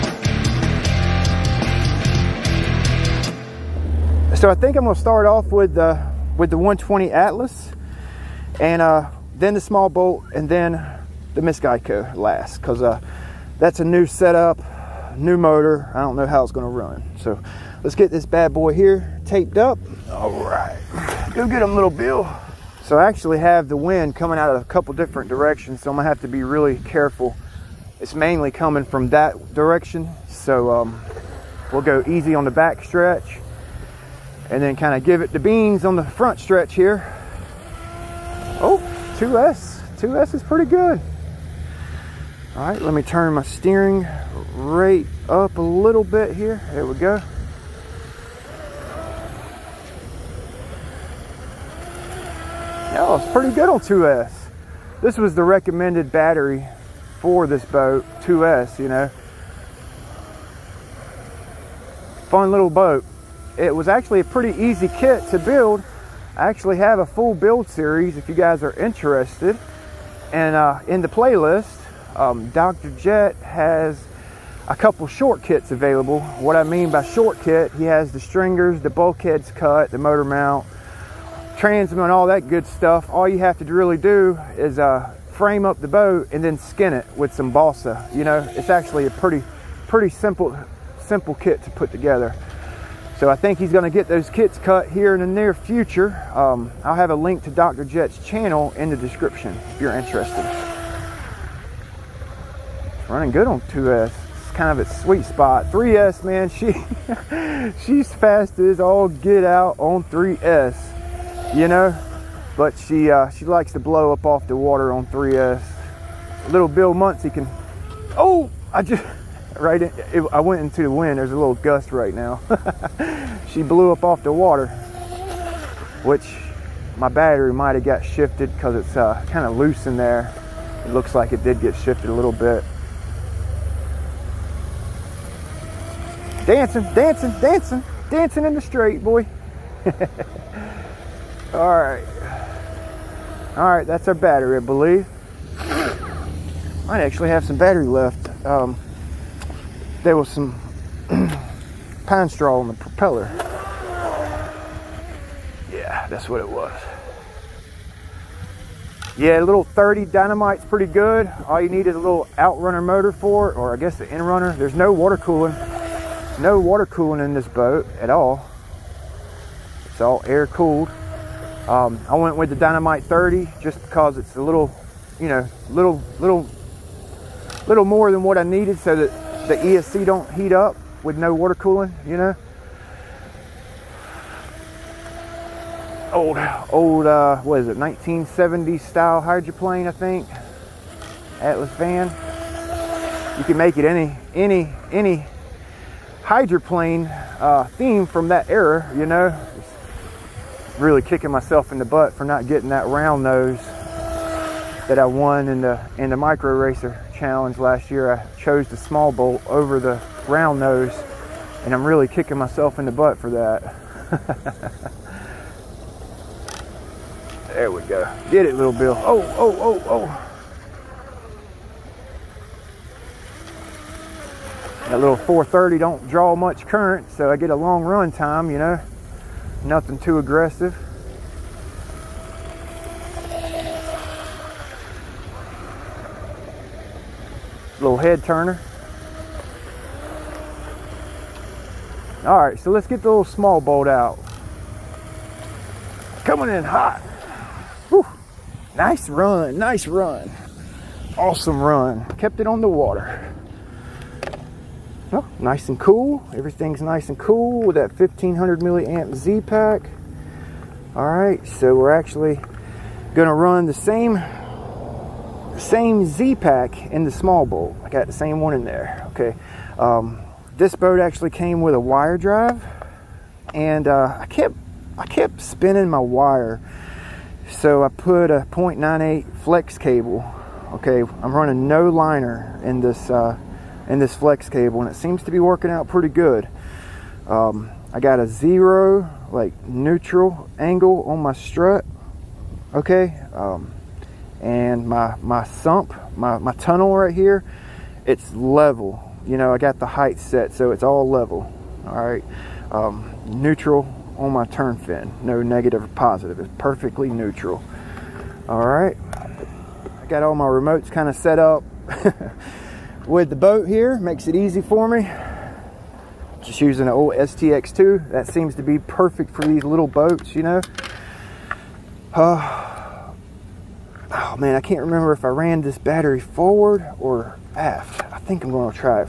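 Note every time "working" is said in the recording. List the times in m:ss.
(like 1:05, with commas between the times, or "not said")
4:45.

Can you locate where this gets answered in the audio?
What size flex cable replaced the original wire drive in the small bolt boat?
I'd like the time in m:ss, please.
4:37.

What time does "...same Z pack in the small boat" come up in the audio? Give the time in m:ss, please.
4:25.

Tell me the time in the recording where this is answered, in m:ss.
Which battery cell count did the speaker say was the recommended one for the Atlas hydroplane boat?
0:55.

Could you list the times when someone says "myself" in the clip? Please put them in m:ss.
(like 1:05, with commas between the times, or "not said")
3:21, 3:32.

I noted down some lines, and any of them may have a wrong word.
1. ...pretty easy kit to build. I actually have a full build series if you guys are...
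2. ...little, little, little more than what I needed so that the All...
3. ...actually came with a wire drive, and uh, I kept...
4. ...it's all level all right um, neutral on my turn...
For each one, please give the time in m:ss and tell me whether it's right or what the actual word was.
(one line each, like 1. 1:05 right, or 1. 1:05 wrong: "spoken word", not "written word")
1. 1:04 right
2. 2:55 wrong: "ESC", not "All"
3. 4:30 right
4. 5:00 right.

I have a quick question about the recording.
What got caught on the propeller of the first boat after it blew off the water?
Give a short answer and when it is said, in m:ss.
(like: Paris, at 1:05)
Pine straw, at 2:32.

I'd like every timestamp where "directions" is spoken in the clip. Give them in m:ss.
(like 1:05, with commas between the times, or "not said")
0:25, 0:29.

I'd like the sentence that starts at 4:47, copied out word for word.
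Um, I got a zero like neutral angle on my strut.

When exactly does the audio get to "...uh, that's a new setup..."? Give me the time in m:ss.
0:12.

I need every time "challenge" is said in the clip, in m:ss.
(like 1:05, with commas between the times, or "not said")
3:27.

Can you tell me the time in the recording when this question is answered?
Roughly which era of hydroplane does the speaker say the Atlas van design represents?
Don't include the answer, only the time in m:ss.
3:07.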